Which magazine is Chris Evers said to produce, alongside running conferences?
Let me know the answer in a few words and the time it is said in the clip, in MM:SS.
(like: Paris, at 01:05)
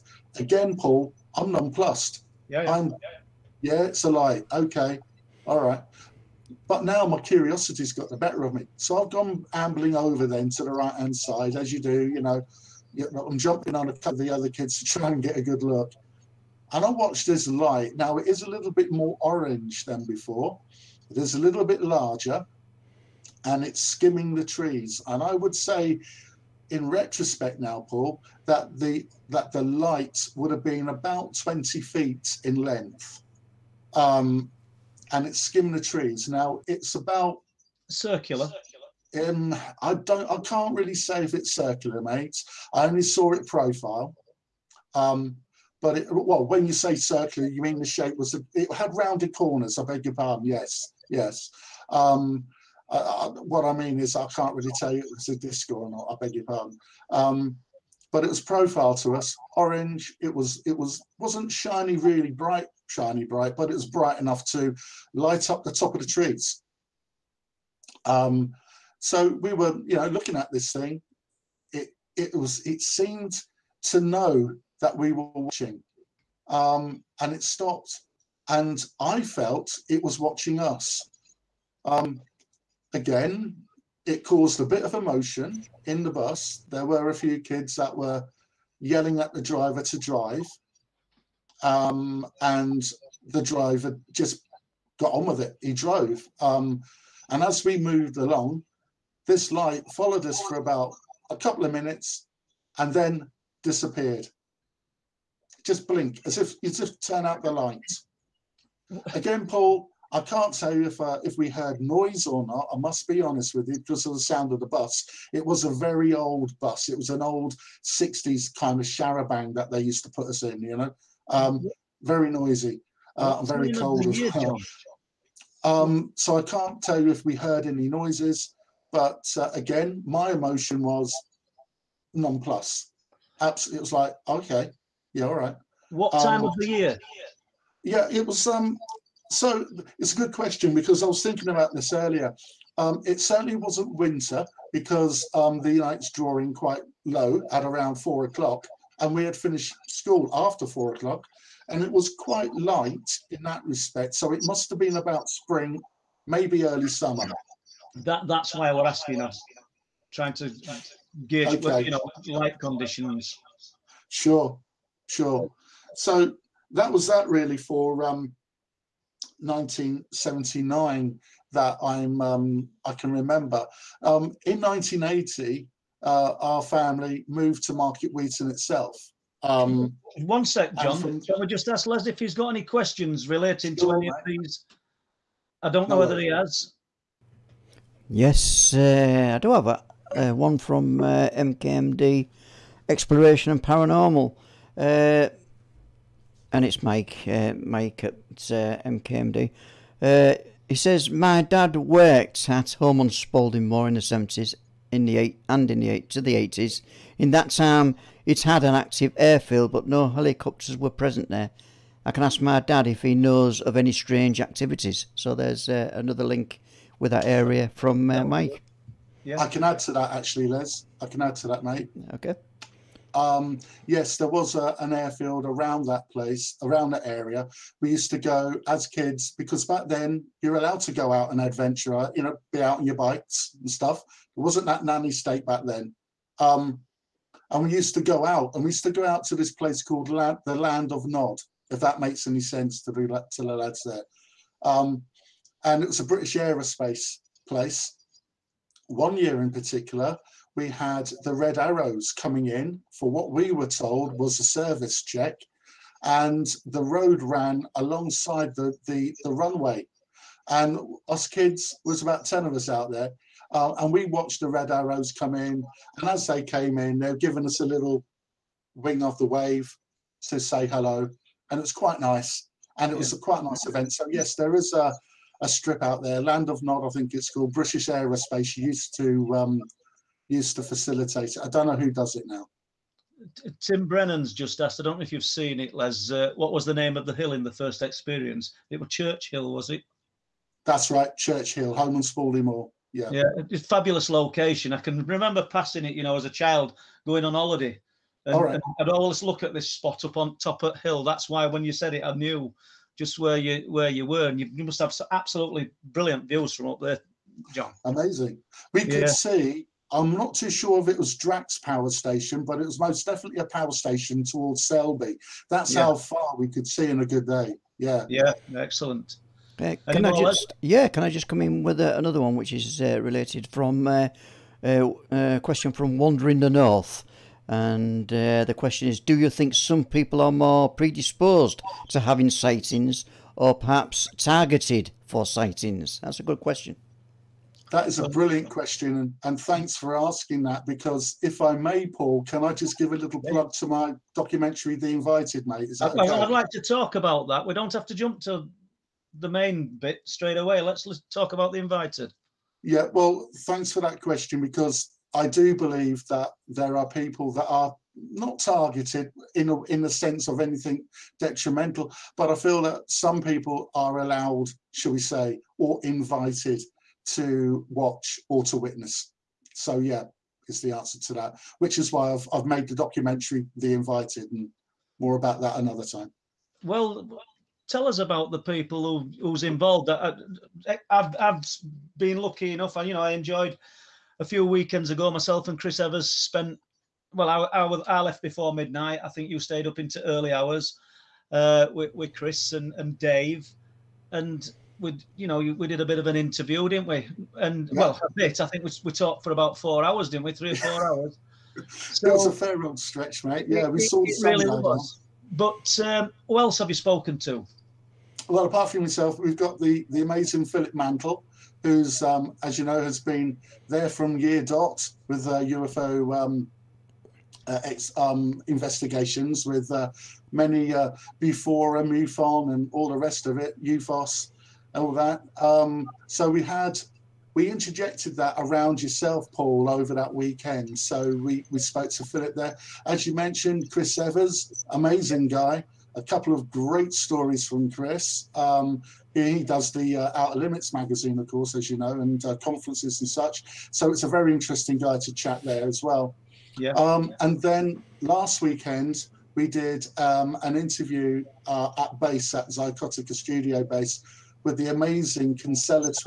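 Outer Limits, at 07:20.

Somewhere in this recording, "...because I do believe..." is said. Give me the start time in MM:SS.
05:54.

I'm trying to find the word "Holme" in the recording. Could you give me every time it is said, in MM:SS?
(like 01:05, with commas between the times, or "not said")
03:22, 04:51.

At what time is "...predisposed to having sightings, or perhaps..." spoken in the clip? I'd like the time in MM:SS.
05:30.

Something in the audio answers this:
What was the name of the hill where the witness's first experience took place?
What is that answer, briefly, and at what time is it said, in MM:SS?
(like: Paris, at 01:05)
Church Hill, at 04:48.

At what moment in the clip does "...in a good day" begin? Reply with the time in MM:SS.
05:16.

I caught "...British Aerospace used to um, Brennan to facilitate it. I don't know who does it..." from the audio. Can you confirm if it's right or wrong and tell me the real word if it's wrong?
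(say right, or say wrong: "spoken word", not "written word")
wrong: "Used", not "Brennan".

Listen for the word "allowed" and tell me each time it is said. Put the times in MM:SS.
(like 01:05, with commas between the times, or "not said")
03:50, 06:03.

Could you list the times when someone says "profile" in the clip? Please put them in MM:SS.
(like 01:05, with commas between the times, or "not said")
00:43, 00:58.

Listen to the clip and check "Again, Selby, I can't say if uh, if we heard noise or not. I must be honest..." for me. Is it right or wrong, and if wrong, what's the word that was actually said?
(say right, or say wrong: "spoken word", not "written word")
wrong: "Paul", not "Selby".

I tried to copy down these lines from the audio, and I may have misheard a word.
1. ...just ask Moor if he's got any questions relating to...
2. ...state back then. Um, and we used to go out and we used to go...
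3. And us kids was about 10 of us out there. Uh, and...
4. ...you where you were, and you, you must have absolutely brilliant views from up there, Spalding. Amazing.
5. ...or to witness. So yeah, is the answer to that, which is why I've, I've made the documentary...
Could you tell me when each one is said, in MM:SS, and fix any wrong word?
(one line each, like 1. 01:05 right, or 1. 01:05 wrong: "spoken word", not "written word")
1. 03:01 wrong: "Les", not "Moor"
2. 03:55 right
3. 04:20 right
4. 05:03 wrong: "John", not "Spalding"
5. 06:08 right.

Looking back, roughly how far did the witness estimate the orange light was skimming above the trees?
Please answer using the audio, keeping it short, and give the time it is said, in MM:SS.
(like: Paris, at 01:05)
20 feet, at 00:31.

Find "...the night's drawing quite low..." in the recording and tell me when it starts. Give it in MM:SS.
02:25.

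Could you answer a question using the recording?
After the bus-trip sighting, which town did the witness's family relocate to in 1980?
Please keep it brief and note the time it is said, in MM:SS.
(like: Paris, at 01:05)
Market Weighton, at 02:57.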